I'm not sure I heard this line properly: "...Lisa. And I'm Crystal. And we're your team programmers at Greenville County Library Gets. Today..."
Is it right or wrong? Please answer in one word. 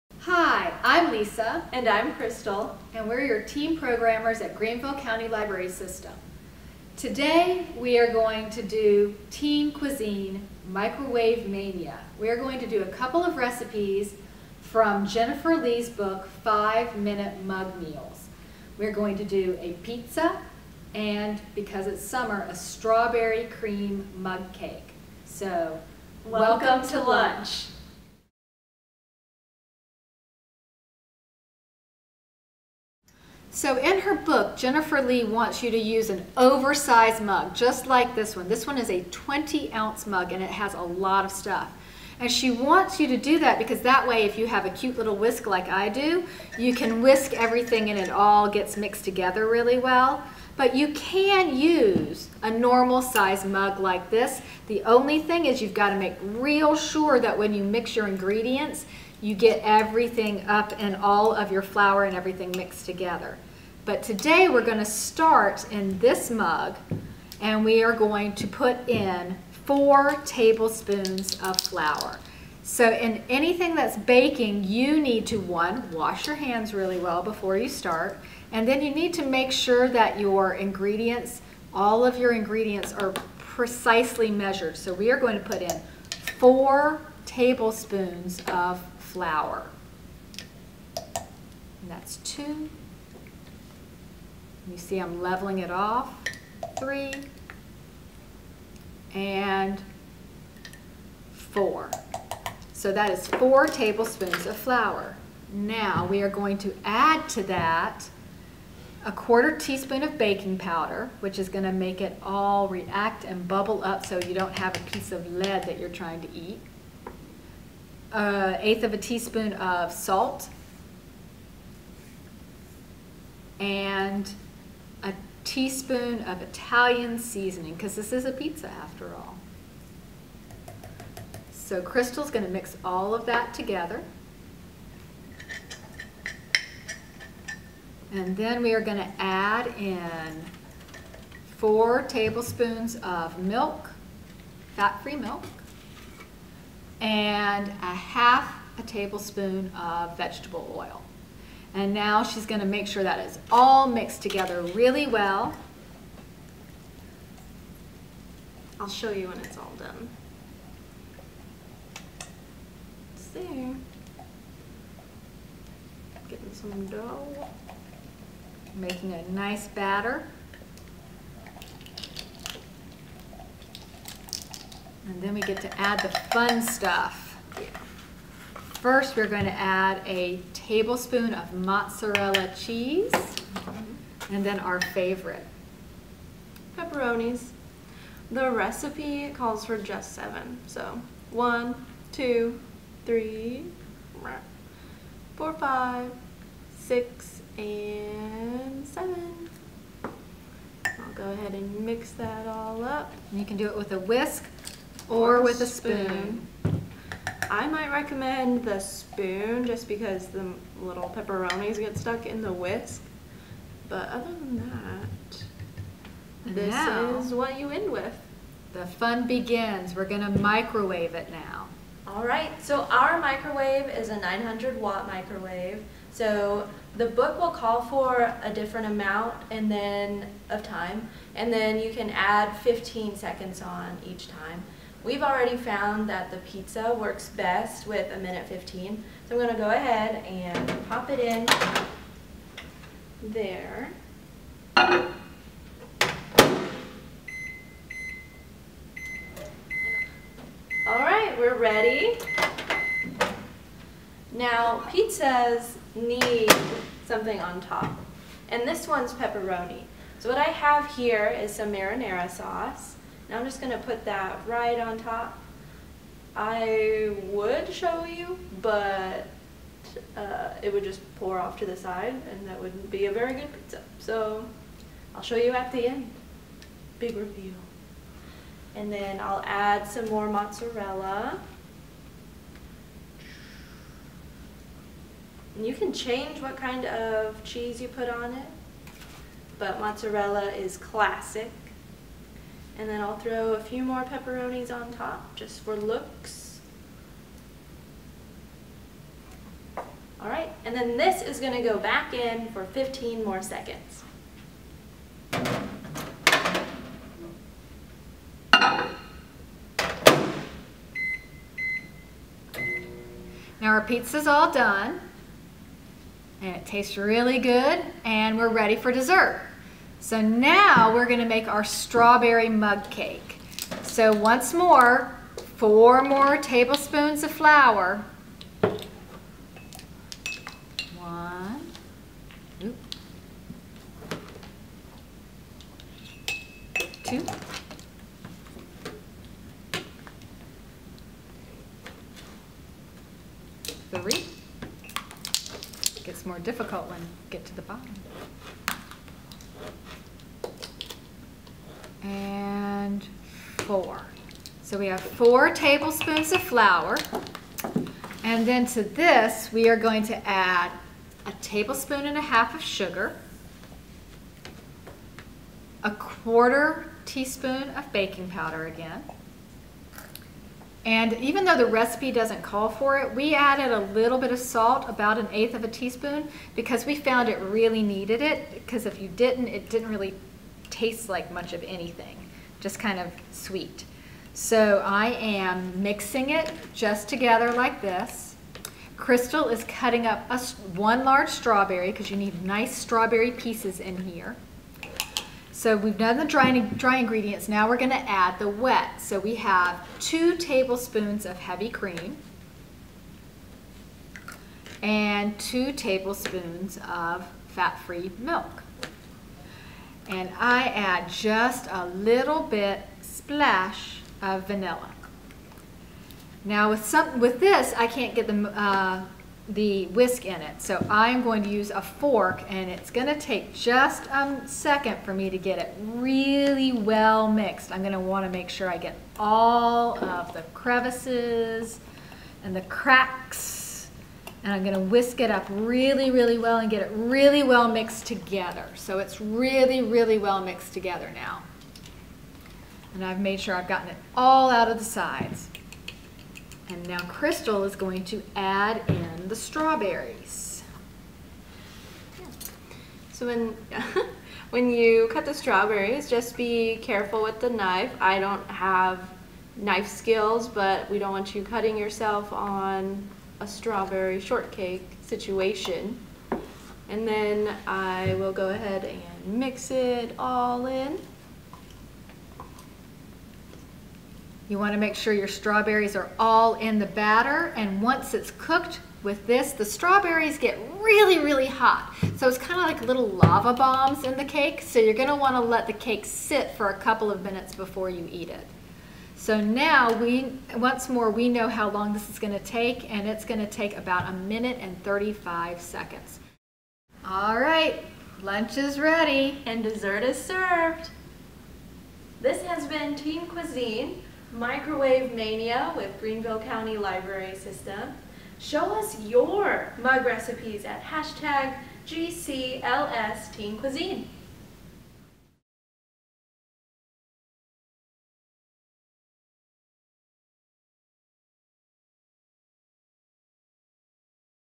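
wrong.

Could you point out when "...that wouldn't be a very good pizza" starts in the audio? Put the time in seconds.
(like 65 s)
272 s.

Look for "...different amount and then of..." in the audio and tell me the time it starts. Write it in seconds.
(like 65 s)
228 s.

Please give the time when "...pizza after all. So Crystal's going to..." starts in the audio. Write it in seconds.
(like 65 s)
128 s.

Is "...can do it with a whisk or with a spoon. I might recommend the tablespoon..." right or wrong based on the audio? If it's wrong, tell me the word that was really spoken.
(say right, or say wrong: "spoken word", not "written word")
wrong: "spoon", not "tablespoon".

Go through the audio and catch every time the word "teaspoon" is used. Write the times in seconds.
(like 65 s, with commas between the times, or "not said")
109 s, 118 s, 125 s, 367 s, 375 s.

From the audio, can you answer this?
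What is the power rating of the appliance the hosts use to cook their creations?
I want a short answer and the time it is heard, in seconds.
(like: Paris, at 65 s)
900 watts, at 224 s.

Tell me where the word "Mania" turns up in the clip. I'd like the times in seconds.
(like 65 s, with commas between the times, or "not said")
11 s, 505 s.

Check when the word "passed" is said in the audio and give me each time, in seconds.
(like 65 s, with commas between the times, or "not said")
not said.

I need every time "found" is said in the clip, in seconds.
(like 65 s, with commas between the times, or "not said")
235 s, 376 s.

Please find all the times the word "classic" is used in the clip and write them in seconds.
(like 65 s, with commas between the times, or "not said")
290 s.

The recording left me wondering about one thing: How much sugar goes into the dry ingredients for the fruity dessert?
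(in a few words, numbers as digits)
1.5 tablespoons.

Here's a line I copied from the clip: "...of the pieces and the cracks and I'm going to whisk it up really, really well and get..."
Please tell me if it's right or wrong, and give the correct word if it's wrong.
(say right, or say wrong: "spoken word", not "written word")
wrong: "crevices", not "pieces".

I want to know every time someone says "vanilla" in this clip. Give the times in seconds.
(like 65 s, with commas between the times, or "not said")
414 s.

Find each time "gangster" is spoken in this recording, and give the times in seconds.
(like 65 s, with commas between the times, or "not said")
not said.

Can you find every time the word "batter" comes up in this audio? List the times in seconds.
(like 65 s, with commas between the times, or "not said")
169 s, 476 s.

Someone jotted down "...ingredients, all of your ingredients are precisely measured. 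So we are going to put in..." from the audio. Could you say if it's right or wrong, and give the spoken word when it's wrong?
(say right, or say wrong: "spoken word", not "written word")
right.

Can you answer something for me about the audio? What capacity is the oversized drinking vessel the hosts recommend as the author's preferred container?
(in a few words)
20 ounces.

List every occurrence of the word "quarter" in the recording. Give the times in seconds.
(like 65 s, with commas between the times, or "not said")
109 s, 365 s.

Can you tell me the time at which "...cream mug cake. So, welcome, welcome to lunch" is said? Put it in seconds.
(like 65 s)
23 s.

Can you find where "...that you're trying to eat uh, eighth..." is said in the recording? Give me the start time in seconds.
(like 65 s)
115 s.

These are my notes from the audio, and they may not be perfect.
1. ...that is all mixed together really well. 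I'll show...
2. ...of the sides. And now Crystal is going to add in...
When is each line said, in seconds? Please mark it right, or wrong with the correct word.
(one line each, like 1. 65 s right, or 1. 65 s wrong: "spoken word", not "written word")
1. 153 s right
2. 444 s right.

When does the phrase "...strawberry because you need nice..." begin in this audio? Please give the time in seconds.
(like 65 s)
391 s.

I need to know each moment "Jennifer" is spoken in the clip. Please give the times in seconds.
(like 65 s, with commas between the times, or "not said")
15 s, 34 s.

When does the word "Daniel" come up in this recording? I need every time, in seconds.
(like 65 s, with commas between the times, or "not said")
not said.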